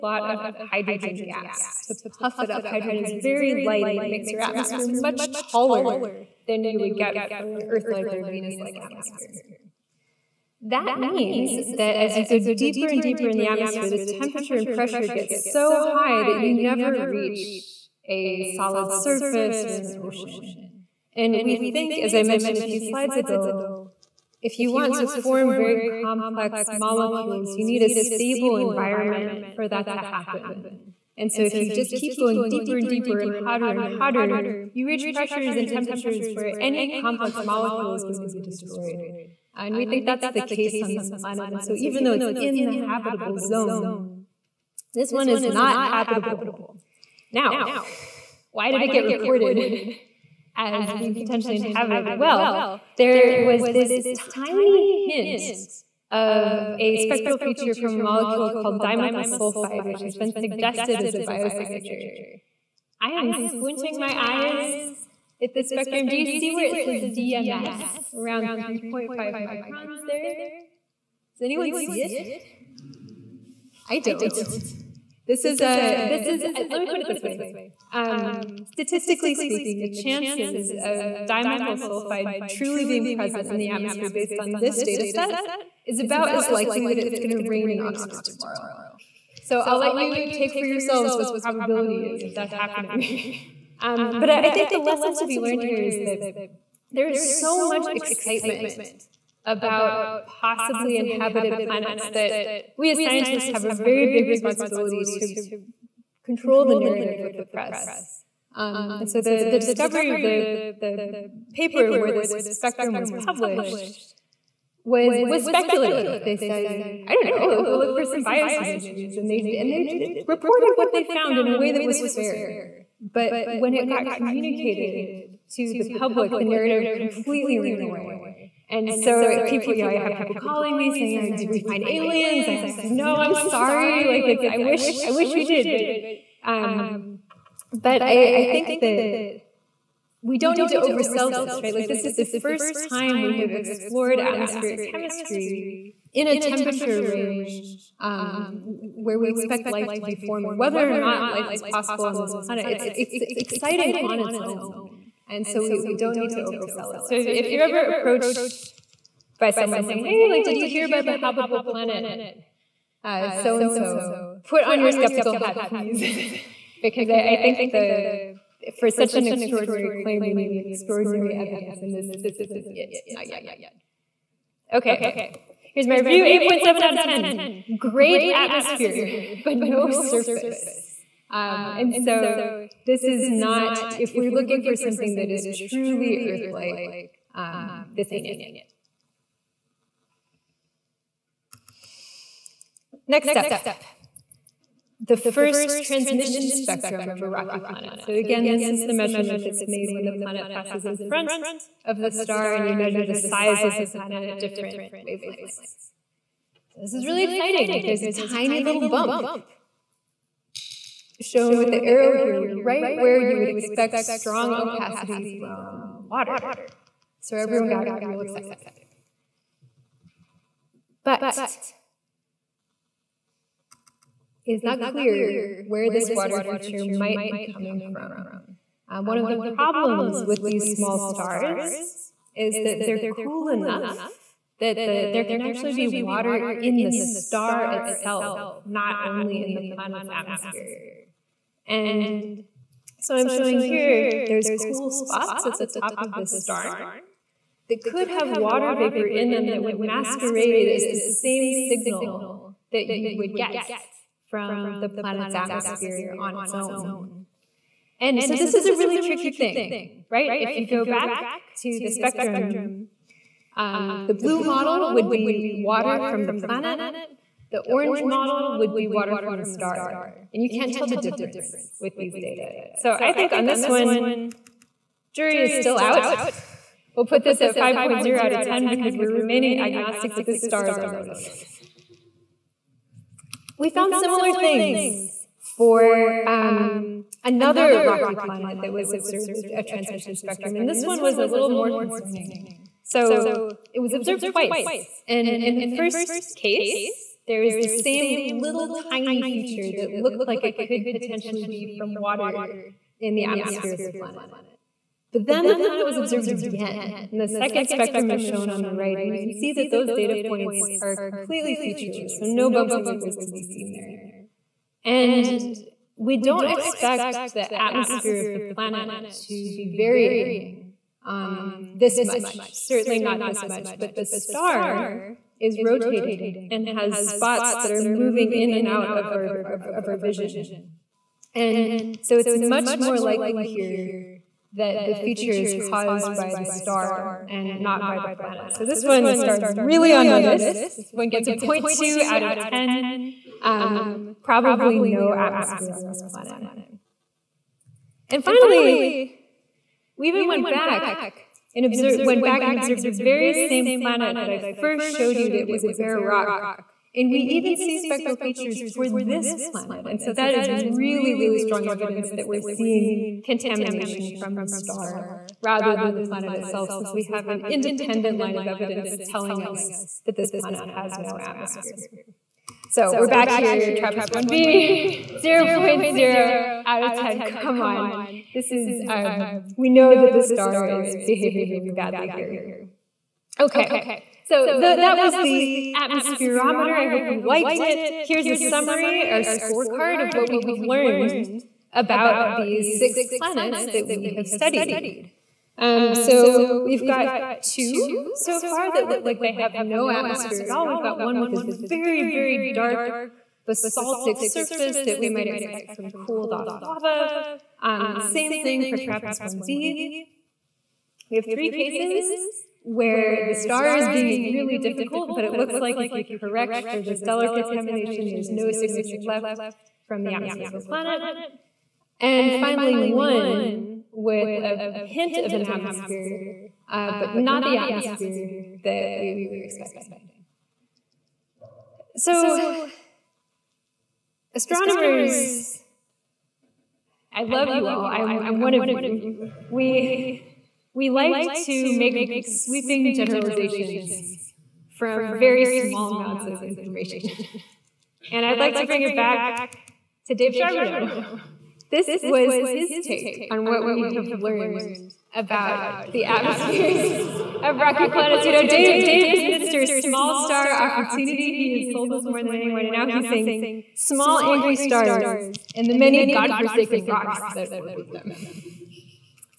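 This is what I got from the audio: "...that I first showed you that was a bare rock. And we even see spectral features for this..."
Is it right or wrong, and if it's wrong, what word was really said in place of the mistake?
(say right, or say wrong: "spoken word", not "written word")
right.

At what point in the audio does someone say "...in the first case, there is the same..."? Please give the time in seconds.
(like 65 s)
295 s.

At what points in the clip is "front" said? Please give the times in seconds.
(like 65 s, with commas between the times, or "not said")
200 s.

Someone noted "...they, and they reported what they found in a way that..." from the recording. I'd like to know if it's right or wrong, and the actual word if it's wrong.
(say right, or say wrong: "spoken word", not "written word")
right.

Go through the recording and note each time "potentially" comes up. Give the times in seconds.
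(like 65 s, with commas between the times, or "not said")
51 s, 300 s.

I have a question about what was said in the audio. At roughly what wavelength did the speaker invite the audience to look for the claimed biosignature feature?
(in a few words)
3.5 microns.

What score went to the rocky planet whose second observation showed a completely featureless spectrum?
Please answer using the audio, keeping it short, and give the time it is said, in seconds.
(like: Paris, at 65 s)
0.2 out of 10, at 341 s.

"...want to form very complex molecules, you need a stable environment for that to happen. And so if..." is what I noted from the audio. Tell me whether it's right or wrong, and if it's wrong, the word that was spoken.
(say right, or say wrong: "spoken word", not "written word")
right.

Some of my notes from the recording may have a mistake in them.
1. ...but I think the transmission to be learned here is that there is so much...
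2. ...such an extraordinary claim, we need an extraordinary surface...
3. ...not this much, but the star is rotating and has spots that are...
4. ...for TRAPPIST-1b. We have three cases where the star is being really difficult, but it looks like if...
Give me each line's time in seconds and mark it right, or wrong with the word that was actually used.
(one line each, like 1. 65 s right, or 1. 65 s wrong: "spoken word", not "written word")
1. 94 s wrong: "lesson", not "transmission"
2. 168 s wrong: "evidence", not "surface"
3. 322 s right
4. 408 s right.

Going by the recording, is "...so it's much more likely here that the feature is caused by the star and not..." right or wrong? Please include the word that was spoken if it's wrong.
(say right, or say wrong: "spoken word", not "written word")
right.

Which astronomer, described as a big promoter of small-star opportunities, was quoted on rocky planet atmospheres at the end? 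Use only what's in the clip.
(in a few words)
Dave Charbonneau.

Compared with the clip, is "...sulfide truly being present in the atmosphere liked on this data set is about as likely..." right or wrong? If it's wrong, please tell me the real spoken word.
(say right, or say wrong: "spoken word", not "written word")
wrong: "based", not "liked".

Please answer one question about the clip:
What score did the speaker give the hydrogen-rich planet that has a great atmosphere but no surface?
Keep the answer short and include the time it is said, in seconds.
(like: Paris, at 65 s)
8.7 out of 10, at 176 s.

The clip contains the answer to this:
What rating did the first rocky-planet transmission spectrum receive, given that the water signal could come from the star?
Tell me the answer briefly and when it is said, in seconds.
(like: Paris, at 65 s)
5.0 out of 10, at 277 s.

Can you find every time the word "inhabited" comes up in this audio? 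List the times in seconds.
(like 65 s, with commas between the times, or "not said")
51 s, 100 s.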